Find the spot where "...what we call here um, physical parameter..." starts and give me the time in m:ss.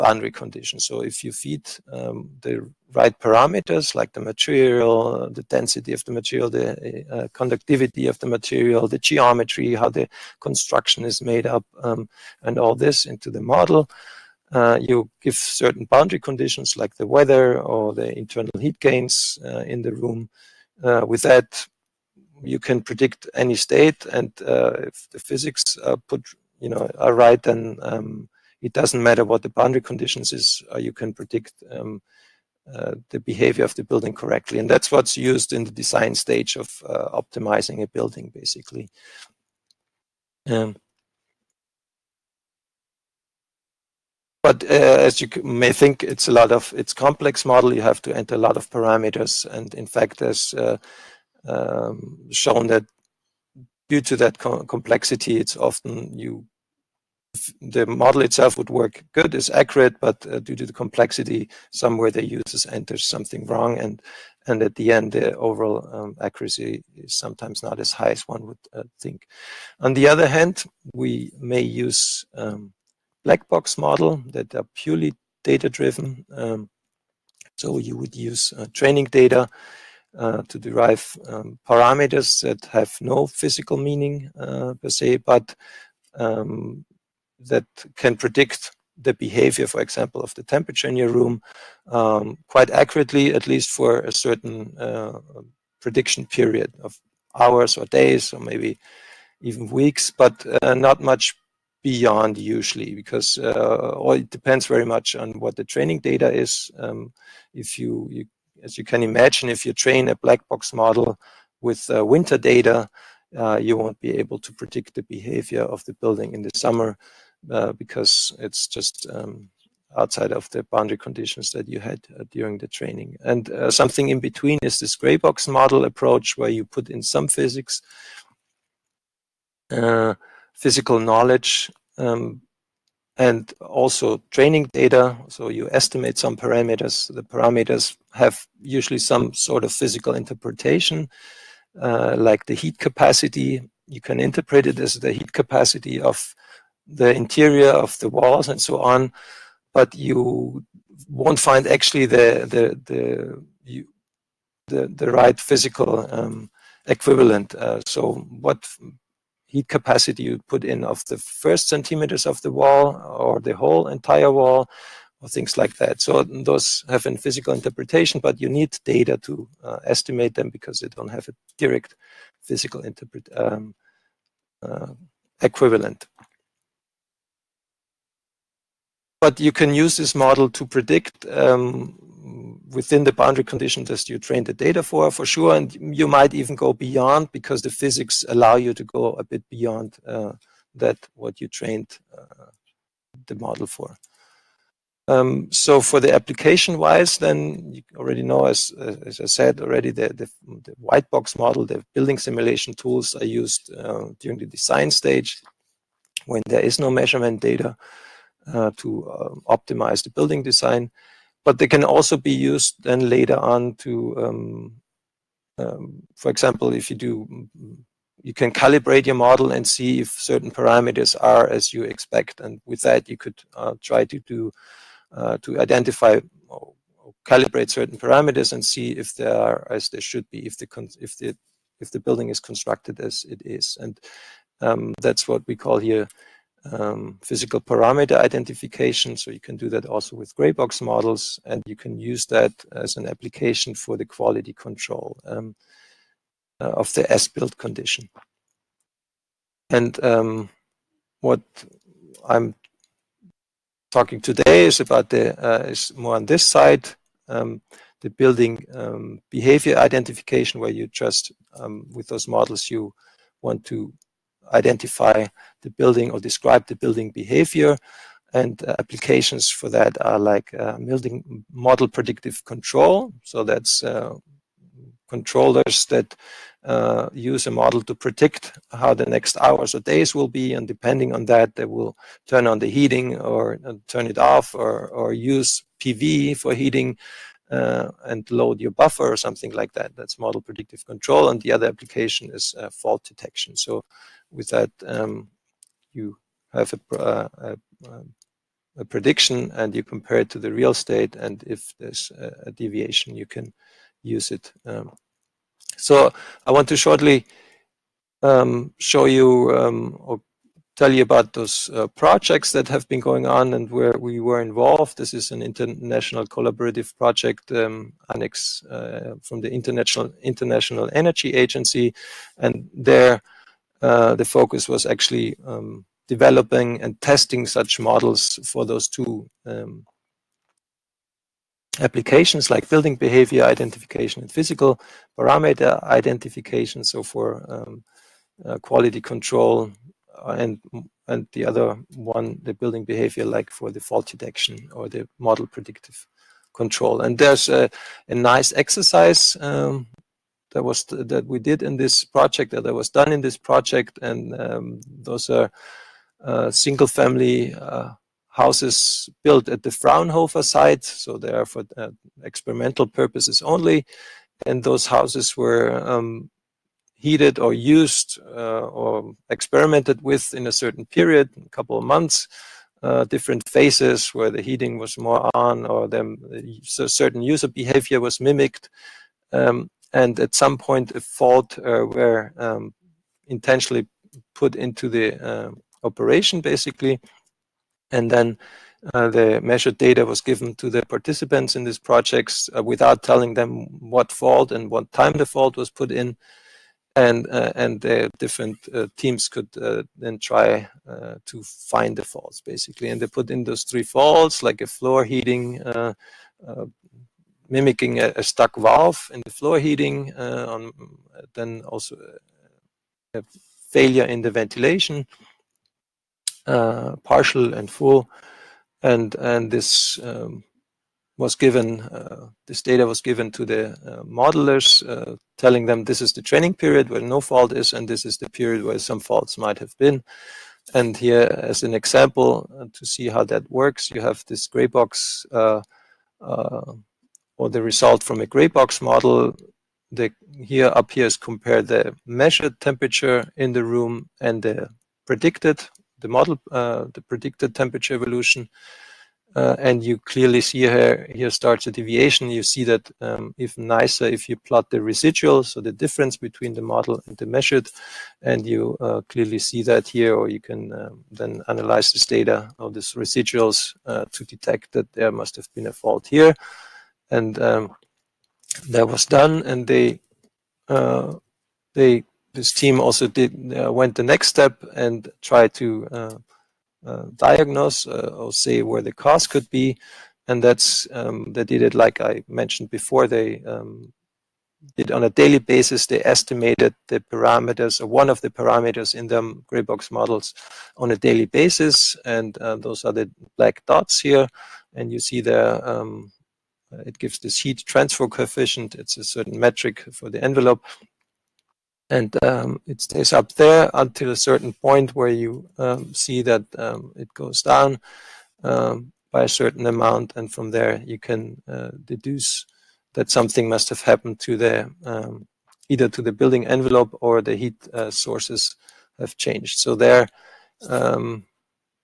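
3:55.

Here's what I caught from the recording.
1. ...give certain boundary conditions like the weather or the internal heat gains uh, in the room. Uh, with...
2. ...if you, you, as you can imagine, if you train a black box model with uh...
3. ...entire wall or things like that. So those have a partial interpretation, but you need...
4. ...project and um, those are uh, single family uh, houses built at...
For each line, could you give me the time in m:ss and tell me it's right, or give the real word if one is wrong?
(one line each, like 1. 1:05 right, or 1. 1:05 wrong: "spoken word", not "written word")
1. 0:15 right
2. 1:47 right
3. 2:43 wrong: "physical", not "partial"
4. 5:53 right.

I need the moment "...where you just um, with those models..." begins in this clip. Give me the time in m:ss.
4:20.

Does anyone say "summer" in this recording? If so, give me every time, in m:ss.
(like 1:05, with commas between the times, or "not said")
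1:56.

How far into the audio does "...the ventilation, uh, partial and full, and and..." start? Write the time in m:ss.
6:54.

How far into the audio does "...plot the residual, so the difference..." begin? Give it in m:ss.
7:34.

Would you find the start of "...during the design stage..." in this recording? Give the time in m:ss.
3:24.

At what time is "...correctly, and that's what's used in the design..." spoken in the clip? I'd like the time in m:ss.
0:34.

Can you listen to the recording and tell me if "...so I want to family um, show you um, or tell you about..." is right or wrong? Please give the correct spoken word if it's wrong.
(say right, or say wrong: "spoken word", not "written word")
wrong: "shortly", not "family".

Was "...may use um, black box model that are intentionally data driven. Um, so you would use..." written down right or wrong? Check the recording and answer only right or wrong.
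wrong.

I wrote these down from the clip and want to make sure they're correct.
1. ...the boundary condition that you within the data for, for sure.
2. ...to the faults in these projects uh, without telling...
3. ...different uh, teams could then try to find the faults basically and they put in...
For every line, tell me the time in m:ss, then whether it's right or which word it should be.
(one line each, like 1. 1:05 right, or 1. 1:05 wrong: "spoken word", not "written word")
1. 3:03 wrong: "train", not "within"
2. 6:30 wrong: "participants", not "faults"
3. 6:38 right.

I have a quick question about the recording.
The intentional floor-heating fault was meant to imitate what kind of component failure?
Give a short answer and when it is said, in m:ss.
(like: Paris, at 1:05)
A stuck valve, at 6:48.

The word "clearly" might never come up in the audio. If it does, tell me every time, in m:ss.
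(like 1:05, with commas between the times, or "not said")
7:29, 7:39.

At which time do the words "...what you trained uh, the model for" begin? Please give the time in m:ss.
3:11.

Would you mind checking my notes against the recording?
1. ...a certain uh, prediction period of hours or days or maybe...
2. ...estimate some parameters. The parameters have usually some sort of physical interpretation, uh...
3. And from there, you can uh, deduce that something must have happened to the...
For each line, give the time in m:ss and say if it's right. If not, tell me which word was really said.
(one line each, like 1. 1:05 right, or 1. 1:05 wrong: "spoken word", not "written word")
1. 1:33 right
2. 2:15 right
3. 8:30 right.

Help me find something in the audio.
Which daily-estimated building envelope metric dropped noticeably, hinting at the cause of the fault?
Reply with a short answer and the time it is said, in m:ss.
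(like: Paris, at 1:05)
Heat transfer coefficient, at 8:17.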